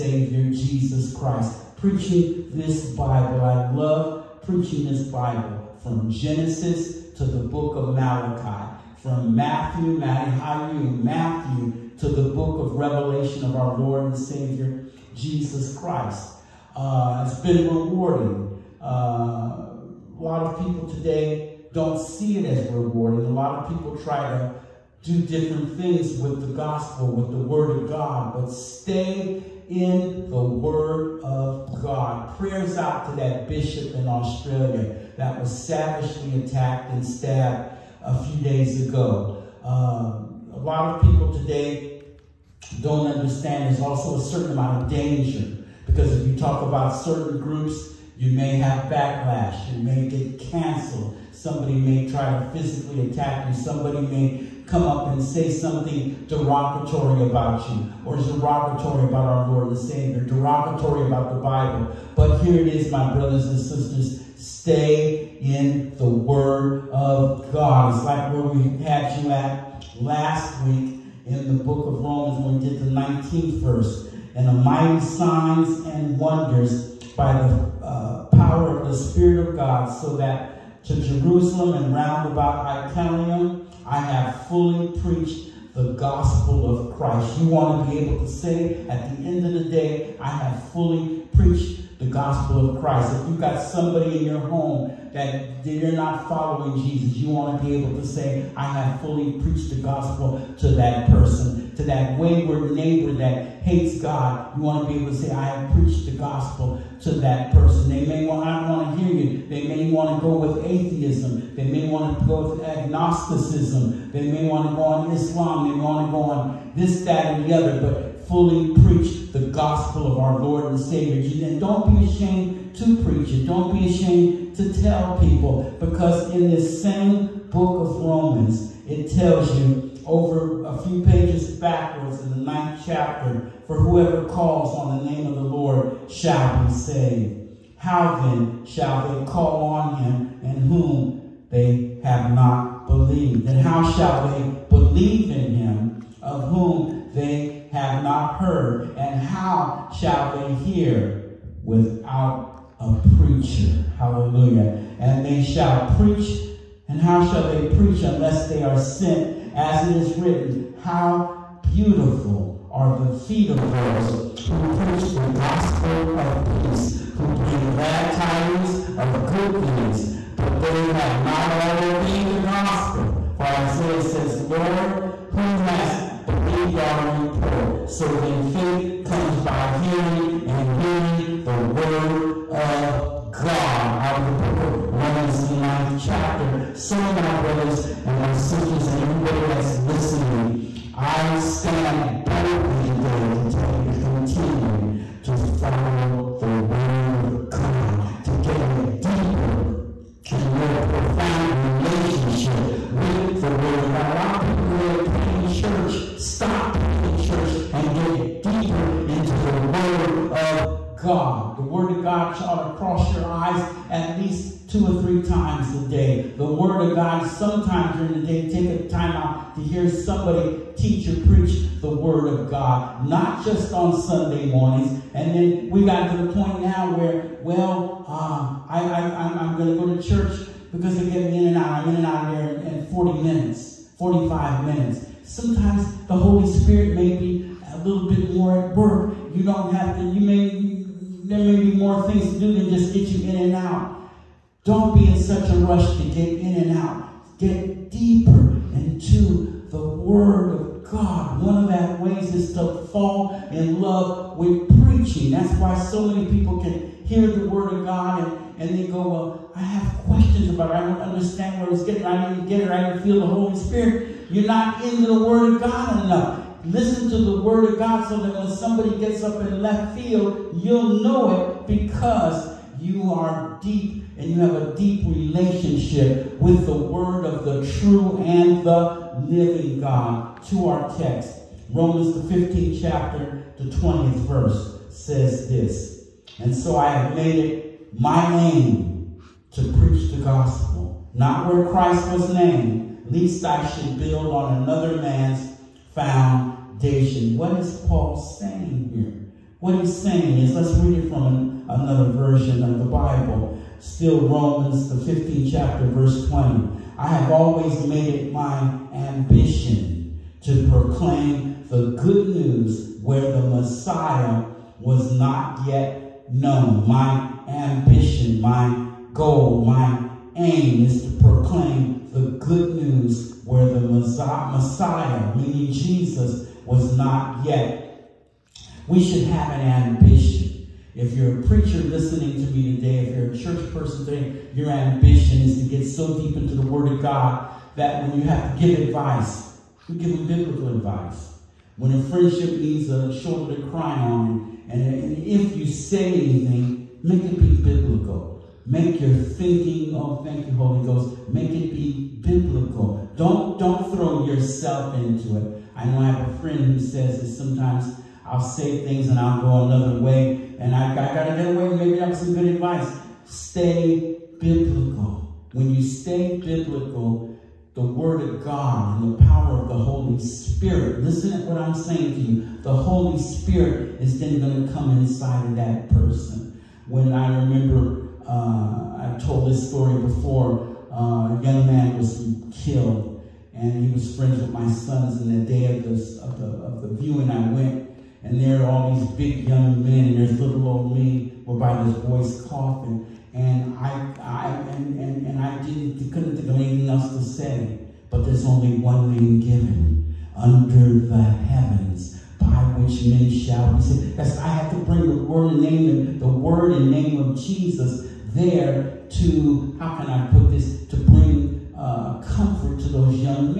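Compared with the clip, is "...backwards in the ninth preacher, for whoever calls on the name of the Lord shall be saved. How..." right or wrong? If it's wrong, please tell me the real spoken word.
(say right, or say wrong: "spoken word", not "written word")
wrong: "chapter", not "preacher".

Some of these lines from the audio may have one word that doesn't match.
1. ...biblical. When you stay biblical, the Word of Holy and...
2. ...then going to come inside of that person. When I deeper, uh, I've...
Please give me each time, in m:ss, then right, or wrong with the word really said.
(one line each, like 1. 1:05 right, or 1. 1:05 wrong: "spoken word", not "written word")
1. 6:04 wrong: "God", not "Holy"
2. 6:14 wrong: "remember", not "deeper".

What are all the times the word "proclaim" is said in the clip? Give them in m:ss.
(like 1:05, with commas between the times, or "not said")
5:10, 5:21.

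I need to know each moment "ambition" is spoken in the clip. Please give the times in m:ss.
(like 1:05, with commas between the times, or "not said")
5:08, 5:17, 5:29, 5:34.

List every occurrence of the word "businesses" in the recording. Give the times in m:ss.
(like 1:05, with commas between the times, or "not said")
not said.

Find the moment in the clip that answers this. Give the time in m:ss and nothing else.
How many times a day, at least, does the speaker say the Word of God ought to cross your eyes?
3:34.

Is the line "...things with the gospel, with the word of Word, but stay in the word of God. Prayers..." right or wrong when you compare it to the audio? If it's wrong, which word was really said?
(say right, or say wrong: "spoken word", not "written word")
wrong: "God", not "Word".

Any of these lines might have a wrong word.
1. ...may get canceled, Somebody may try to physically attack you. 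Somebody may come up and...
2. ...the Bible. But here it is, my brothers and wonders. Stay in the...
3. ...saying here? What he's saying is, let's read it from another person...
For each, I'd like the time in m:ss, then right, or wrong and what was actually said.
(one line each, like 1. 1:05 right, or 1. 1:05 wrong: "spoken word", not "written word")
1. 0:49 right
2. 1:01 wrong: "sisters", not "wonders"
3. 4:58 wrong: "version", not "person".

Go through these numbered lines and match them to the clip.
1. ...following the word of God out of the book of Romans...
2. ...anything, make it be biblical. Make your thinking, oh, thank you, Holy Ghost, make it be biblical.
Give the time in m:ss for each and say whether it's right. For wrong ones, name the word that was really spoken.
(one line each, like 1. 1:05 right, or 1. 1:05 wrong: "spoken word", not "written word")
1. 3:00 wrong: "hearing", not "following"
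2. 5:46 right.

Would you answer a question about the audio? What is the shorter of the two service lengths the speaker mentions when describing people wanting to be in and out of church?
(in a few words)
40 minutes.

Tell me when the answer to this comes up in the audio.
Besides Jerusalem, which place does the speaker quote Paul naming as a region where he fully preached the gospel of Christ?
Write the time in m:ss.
1:22.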